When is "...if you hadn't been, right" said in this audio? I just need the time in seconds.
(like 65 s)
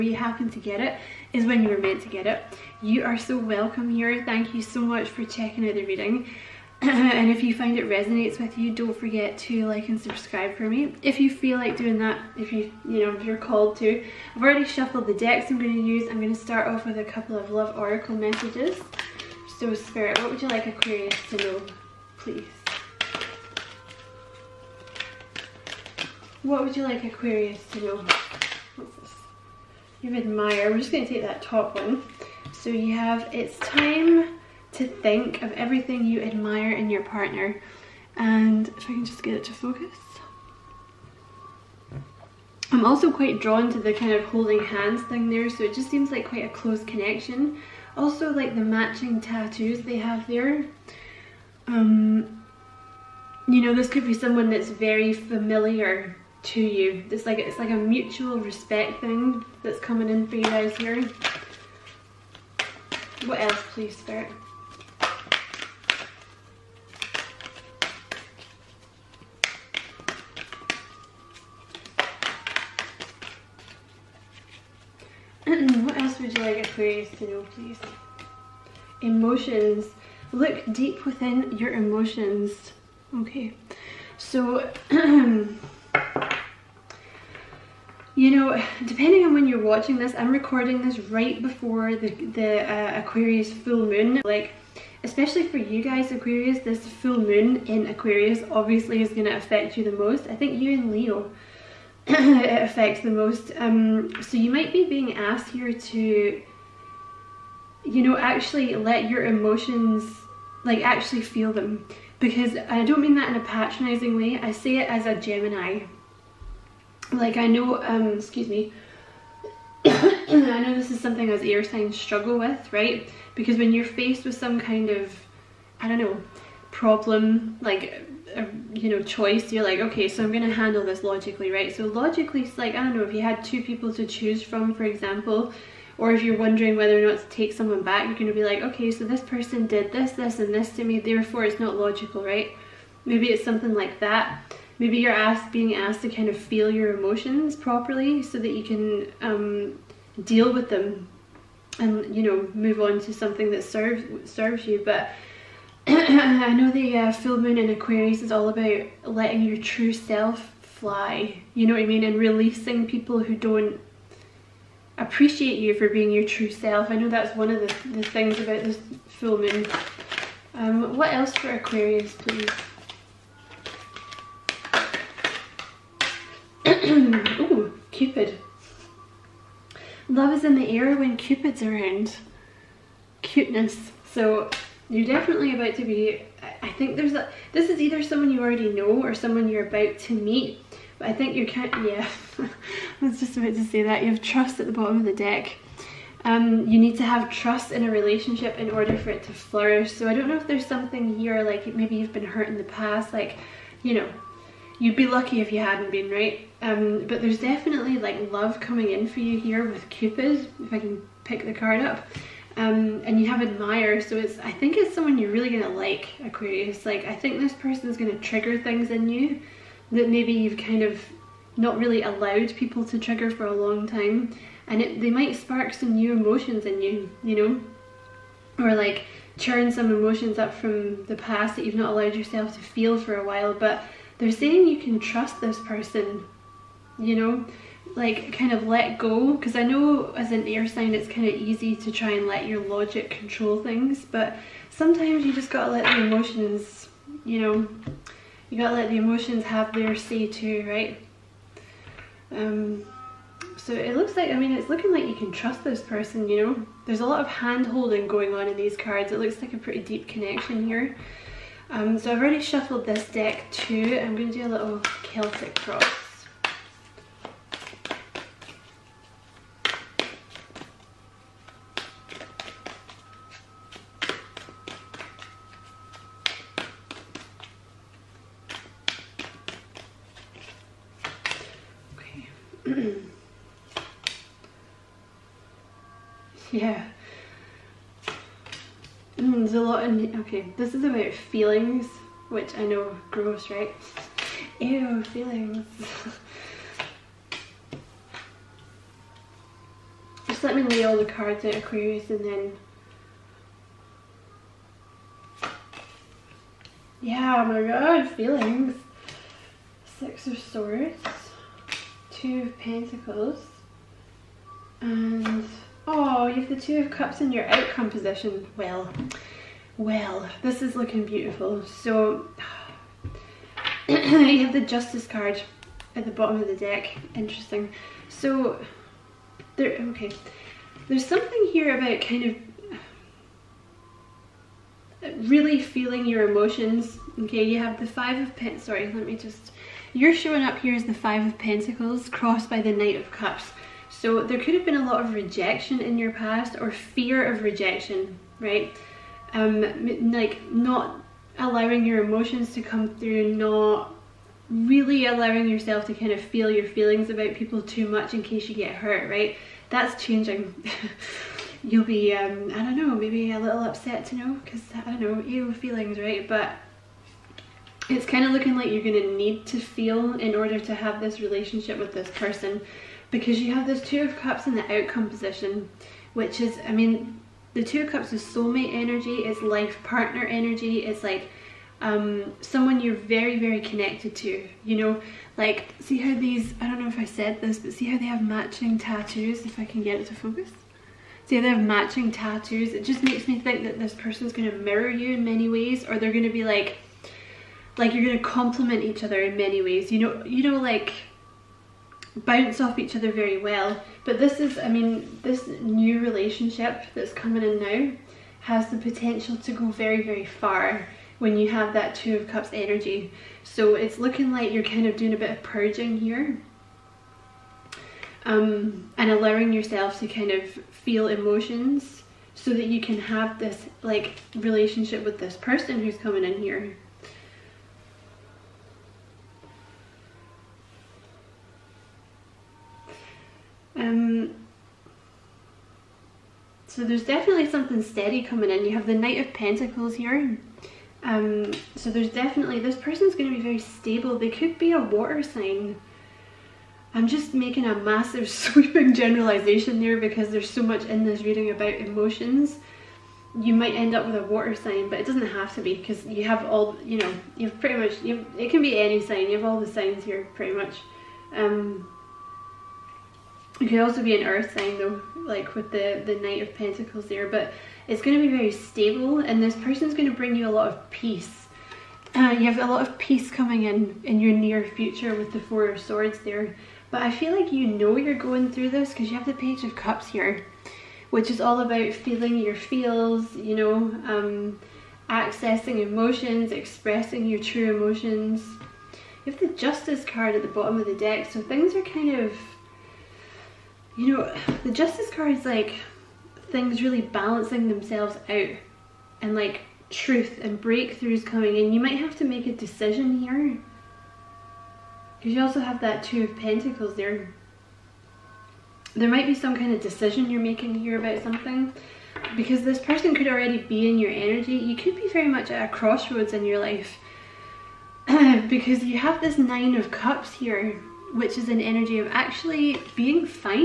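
205 s.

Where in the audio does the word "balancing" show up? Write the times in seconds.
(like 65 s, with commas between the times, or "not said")
497 s.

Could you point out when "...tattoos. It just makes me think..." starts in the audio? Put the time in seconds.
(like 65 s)
392 s.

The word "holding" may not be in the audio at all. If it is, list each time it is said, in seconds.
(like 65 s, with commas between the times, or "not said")
44 s, 257 s.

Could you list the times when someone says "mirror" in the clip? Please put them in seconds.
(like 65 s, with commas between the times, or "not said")
394 s.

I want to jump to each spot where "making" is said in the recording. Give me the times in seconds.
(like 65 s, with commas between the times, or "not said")
447 s, 510 s.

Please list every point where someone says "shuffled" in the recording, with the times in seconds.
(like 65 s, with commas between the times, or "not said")
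14 s, 262 s.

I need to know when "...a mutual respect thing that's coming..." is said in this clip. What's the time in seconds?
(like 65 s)
57 s.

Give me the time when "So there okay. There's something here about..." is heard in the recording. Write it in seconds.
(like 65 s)
328 s.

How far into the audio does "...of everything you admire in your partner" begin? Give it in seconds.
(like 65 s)
35 s.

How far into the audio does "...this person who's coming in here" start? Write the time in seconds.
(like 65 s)
425 s.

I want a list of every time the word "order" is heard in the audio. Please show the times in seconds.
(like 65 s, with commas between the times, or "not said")
198 s, 370 s.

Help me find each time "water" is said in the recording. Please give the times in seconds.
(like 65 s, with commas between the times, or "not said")
444 s, 454 s.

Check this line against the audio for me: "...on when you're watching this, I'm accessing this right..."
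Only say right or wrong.
wrong.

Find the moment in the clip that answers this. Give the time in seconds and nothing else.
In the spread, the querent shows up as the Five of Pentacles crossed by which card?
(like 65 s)
342 s.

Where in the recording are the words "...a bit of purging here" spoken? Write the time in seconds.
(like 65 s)
415 s.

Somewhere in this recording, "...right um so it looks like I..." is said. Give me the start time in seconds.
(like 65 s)
250 s.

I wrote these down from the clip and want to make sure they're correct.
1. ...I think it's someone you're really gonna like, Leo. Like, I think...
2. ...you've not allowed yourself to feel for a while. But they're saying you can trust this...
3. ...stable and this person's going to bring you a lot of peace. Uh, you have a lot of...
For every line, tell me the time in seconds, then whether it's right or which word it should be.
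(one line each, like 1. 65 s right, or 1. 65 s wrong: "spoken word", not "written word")
1. 214 s wrong: "Aquarius", not "Leo"
2. 231 s right
3. 468 s right.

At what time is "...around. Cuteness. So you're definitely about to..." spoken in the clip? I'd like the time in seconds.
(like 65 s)
181 s.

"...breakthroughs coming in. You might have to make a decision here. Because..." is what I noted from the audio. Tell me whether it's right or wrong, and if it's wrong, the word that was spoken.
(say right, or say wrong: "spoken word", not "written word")
right.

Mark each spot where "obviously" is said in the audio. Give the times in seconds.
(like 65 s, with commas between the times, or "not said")
98 s.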